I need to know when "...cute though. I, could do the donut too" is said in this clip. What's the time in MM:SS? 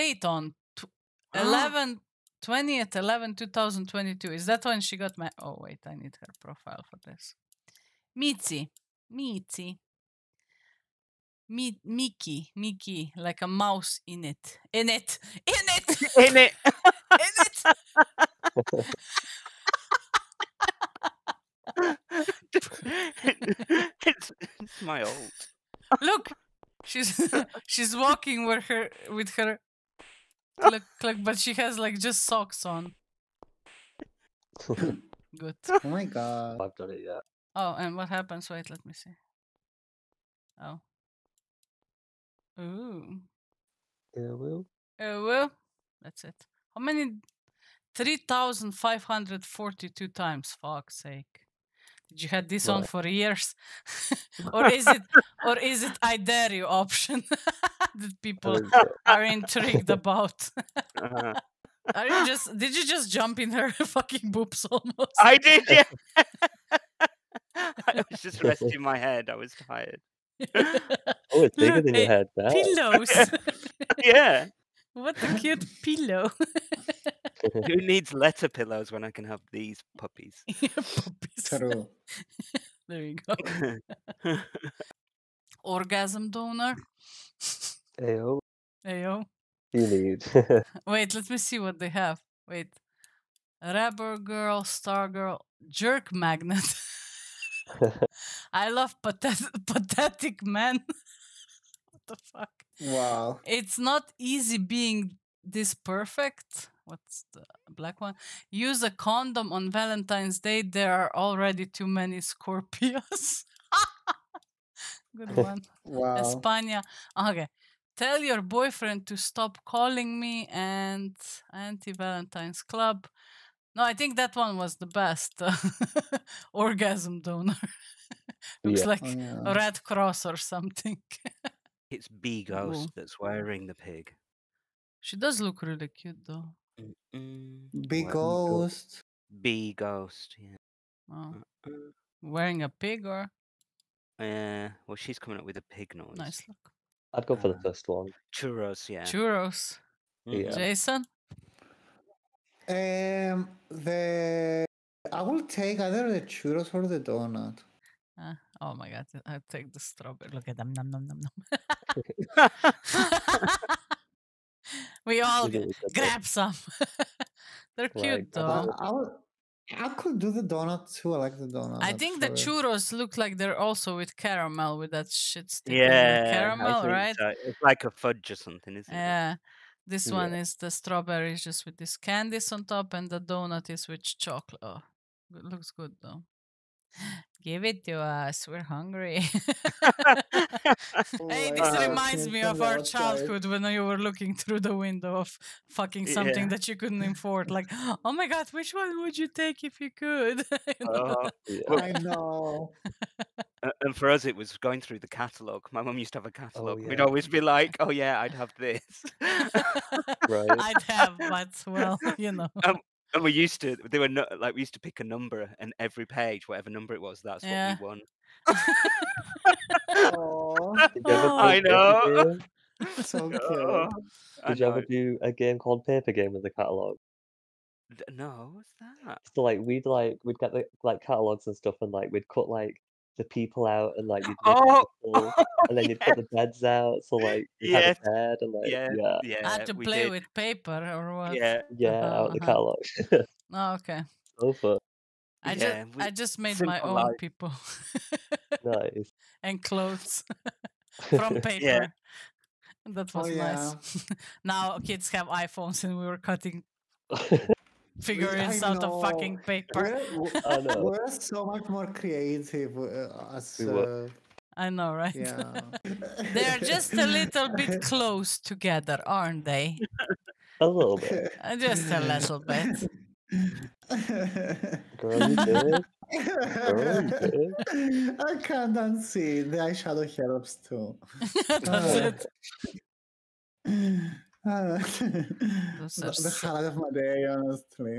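02:48.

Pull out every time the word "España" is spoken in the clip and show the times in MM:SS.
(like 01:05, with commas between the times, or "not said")
01:56.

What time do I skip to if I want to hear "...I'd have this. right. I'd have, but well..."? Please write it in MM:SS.
03:28.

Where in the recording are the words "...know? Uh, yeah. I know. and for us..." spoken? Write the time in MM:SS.
03:20.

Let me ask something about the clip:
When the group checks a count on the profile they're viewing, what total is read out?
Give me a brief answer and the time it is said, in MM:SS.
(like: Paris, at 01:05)
3542, at 00:47.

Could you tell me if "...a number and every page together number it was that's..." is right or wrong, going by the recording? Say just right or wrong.
wrong.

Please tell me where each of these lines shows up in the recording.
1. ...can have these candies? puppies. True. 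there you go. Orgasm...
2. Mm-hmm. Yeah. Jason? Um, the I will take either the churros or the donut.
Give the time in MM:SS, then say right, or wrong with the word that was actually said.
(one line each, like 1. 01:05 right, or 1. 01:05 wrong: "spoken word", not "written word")
1. 01:19 wrong: "puppies", not "candies"
2. 02:30 right.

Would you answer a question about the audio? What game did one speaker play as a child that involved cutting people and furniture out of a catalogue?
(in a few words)
Paper game.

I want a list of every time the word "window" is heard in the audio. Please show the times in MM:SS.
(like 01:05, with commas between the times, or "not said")
03:14.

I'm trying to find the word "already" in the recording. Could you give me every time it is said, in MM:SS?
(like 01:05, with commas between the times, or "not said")
01:51.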